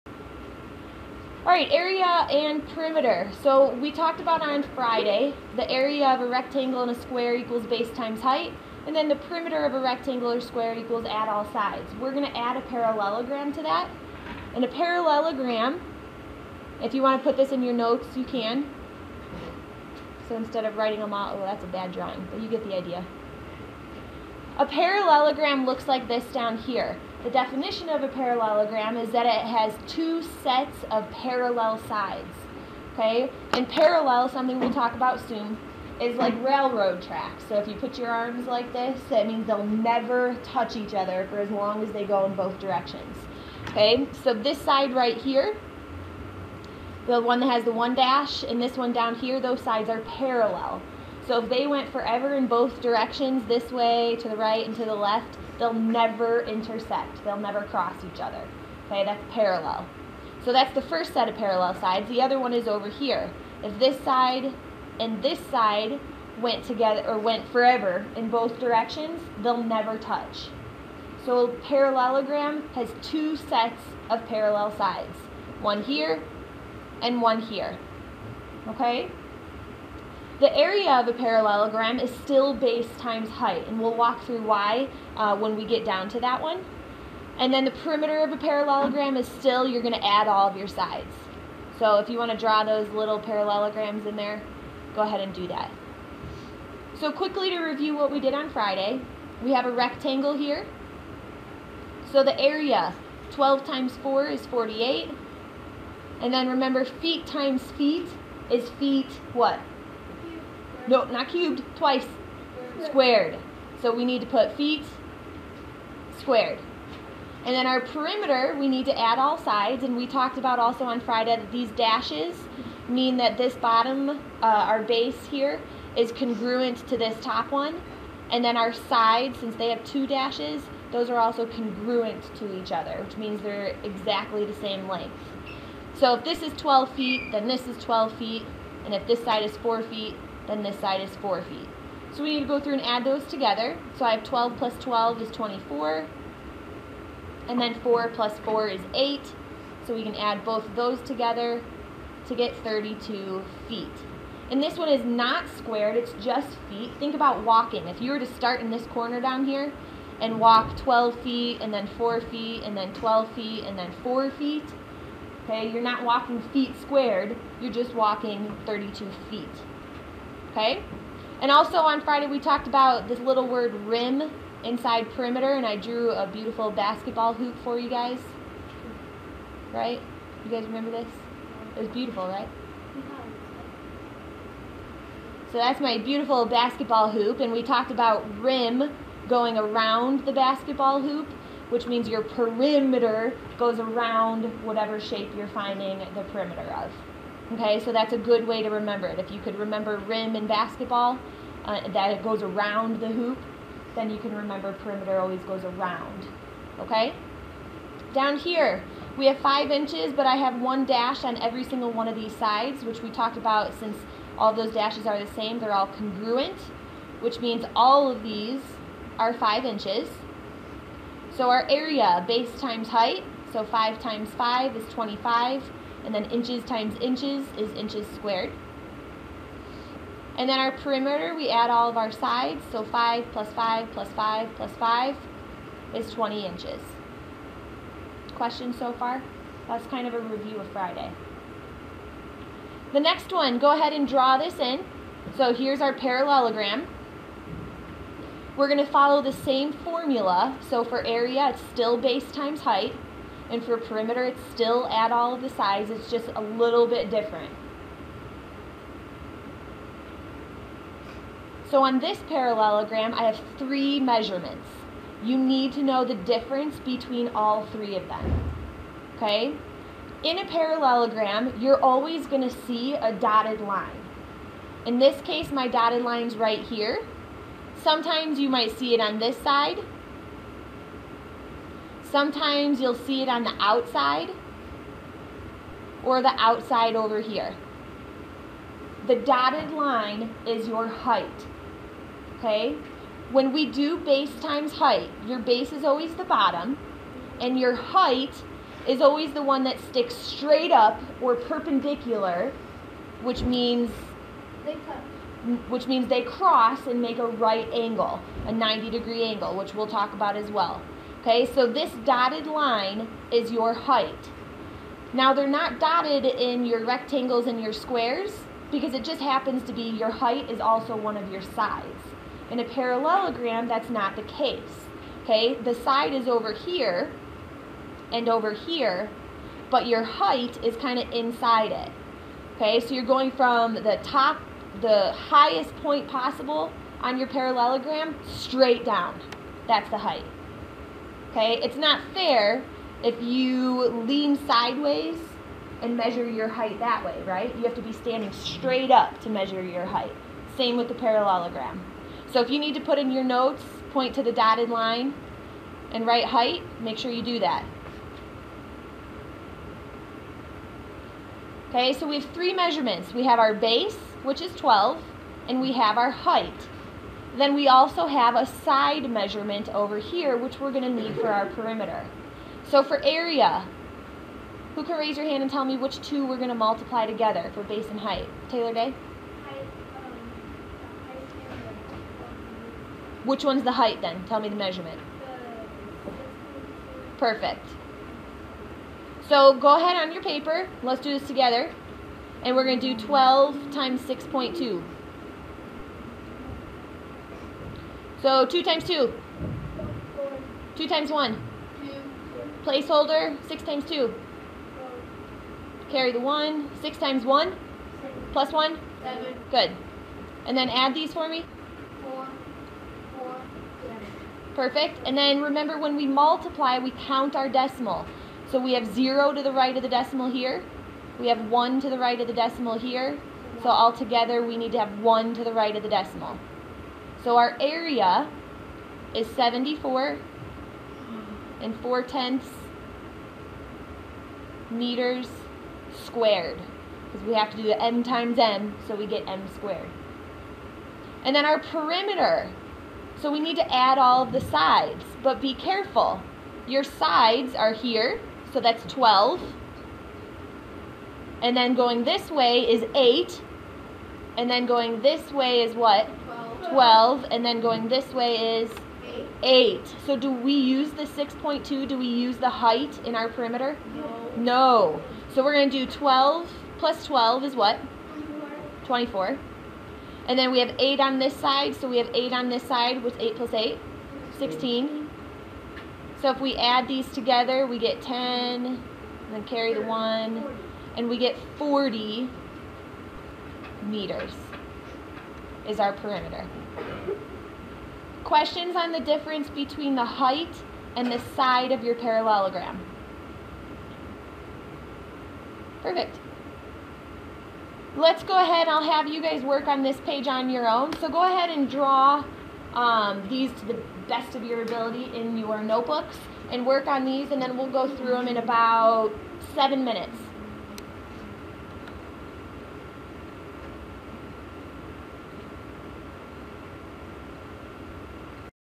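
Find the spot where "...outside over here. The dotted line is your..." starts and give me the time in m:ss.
4:46.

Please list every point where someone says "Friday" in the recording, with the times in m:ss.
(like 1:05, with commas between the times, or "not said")
0:04, 1:38, 2:00, 2:52, 4:00.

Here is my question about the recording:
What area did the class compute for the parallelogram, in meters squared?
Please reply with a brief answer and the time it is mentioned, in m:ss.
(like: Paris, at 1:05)
74.4, at 7:09.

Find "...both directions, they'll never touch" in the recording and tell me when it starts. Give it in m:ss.
1:08.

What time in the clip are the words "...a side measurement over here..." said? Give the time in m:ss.
6:08.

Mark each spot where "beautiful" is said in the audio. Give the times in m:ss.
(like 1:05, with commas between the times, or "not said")
2:56, 3:01, 3:05.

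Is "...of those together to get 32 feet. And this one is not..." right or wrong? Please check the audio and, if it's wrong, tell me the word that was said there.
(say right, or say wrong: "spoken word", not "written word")
right.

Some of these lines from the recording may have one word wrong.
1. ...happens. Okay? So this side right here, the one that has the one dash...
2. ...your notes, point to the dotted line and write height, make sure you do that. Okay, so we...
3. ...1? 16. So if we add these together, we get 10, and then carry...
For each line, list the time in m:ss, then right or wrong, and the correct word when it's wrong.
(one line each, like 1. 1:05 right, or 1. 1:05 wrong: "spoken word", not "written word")
1. 0:42 wrong: "directions", not "happens"
2. 5:53 right
3. 7:53 wrong: "8", not "1".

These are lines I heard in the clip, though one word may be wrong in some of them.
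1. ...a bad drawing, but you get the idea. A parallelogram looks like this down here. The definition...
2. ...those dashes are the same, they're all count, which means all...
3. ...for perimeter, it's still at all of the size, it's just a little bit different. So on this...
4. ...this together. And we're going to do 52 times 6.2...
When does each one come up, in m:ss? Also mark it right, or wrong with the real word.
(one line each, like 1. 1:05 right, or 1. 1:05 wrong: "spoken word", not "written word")
1. 0:21 right
2. 3:34 wrong: "congruent", not "count"
3. 4:13 right
4. 6:31 wrong: "12", not "52".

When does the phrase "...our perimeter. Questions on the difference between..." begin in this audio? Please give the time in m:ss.
8:05.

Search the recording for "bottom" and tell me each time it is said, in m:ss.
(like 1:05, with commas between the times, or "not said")
2:03, 4:56.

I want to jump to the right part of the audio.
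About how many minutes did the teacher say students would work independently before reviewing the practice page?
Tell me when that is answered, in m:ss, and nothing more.
8:29.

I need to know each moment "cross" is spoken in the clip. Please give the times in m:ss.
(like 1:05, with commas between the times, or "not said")
0:57, 5:06.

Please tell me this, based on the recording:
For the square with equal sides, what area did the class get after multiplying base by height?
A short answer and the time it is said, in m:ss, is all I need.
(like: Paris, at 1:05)
25 inches squared, at 3:44.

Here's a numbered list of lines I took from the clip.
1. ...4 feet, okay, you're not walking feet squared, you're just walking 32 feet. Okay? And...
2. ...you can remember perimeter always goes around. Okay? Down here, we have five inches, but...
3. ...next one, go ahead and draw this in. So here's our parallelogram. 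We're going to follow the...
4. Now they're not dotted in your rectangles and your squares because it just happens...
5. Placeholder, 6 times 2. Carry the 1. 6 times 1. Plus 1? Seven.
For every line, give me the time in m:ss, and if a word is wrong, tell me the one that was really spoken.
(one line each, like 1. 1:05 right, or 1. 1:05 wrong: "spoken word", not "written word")
1. 2:44 right
2. 3:24 right
3. 4:02 right
4. 5:15 right
5. 6:42 right.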